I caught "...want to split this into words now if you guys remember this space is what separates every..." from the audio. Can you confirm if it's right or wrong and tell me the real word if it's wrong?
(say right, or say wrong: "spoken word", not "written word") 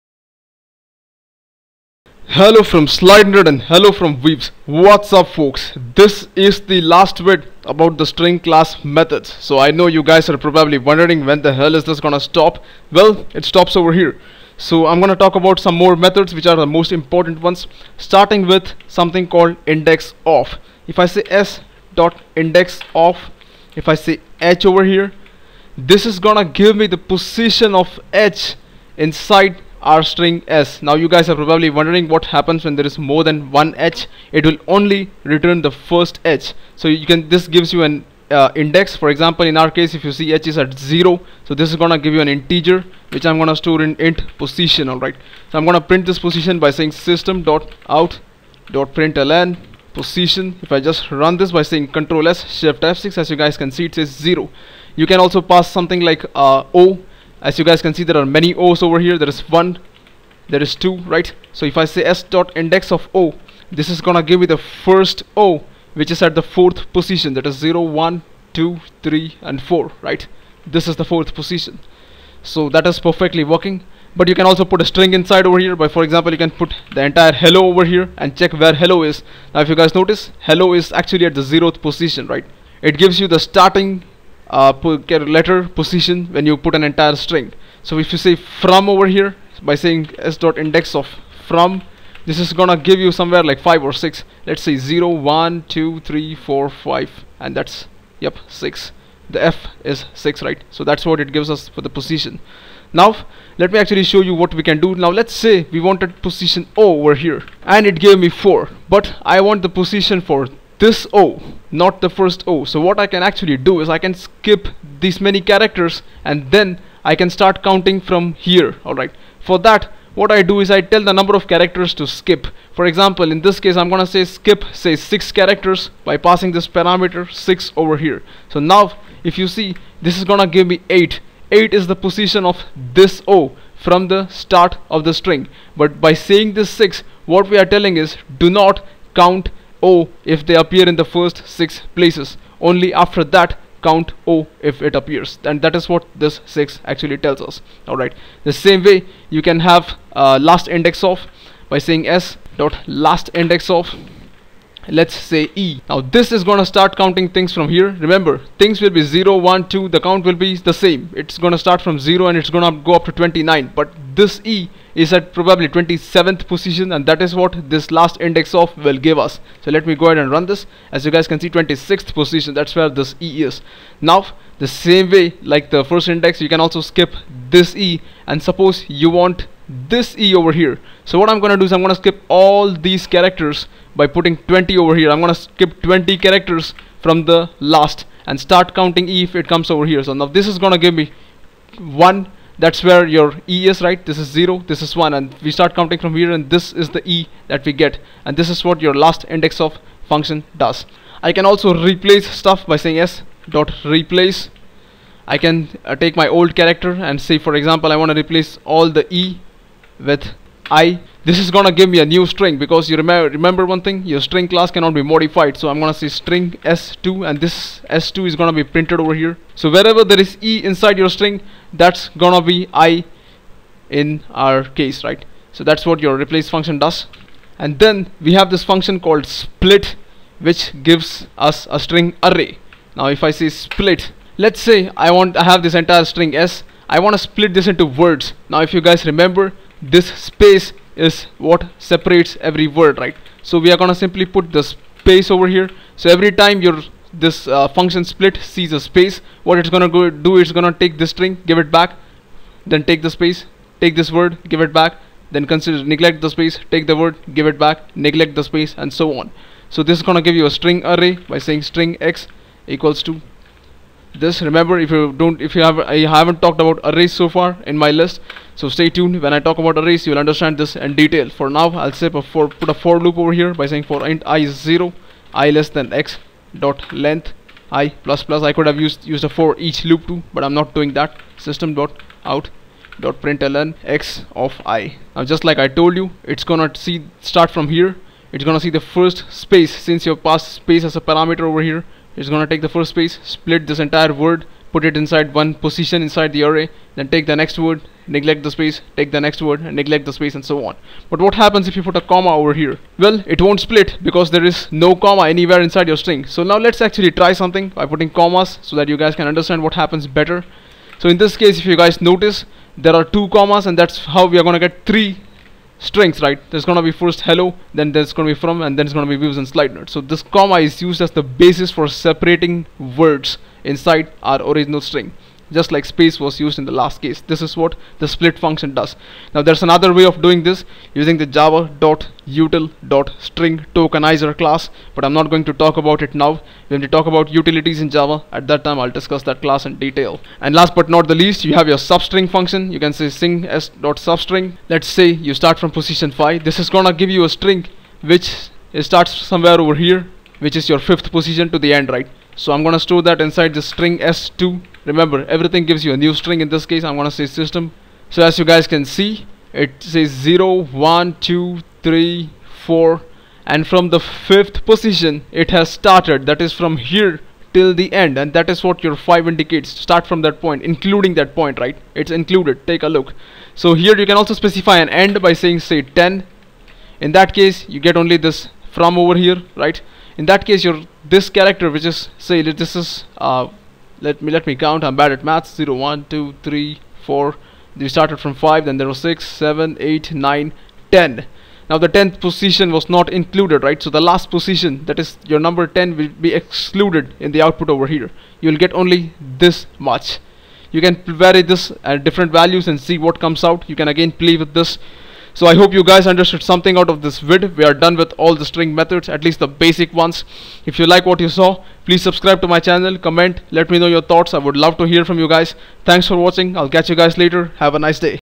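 right.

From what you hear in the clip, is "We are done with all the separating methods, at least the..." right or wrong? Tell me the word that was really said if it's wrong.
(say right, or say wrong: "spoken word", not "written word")
wrong: "string", not "separating".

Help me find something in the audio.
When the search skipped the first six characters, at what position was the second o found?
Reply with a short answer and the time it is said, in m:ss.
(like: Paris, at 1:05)
8, at 2:11.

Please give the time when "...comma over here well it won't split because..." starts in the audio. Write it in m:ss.
5:02.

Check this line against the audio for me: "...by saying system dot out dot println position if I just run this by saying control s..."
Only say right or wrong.
right.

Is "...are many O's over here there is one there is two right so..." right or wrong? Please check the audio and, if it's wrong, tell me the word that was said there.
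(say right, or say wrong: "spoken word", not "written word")
right.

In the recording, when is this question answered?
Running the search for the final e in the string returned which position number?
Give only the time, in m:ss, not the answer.
2:51.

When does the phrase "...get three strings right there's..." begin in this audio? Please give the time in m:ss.
5:14.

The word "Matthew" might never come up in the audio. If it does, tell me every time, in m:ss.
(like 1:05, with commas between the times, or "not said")
not said.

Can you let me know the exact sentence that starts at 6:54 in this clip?
I would love to hear from you guys.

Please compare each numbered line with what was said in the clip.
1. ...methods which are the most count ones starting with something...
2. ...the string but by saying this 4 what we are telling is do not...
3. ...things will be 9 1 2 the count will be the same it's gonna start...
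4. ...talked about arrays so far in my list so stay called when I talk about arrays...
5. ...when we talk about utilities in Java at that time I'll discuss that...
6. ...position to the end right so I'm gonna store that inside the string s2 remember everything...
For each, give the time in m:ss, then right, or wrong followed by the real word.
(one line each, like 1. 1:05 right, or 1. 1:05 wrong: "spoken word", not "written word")
1. 0:15 wrong: "important", not "count"
2. 2:15 wrong: "6", not "4"
3. 2:38 wrong: "0", not "9"
4. 4:26 wrong: "tuned", not "called"
5. 5:36 right
6. 5:51 right.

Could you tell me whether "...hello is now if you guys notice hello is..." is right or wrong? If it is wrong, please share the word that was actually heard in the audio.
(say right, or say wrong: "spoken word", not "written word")
right.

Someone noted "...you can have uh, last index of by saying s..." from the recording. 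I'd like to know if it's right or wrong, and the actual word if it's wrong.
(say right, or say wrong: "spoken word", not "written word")
right.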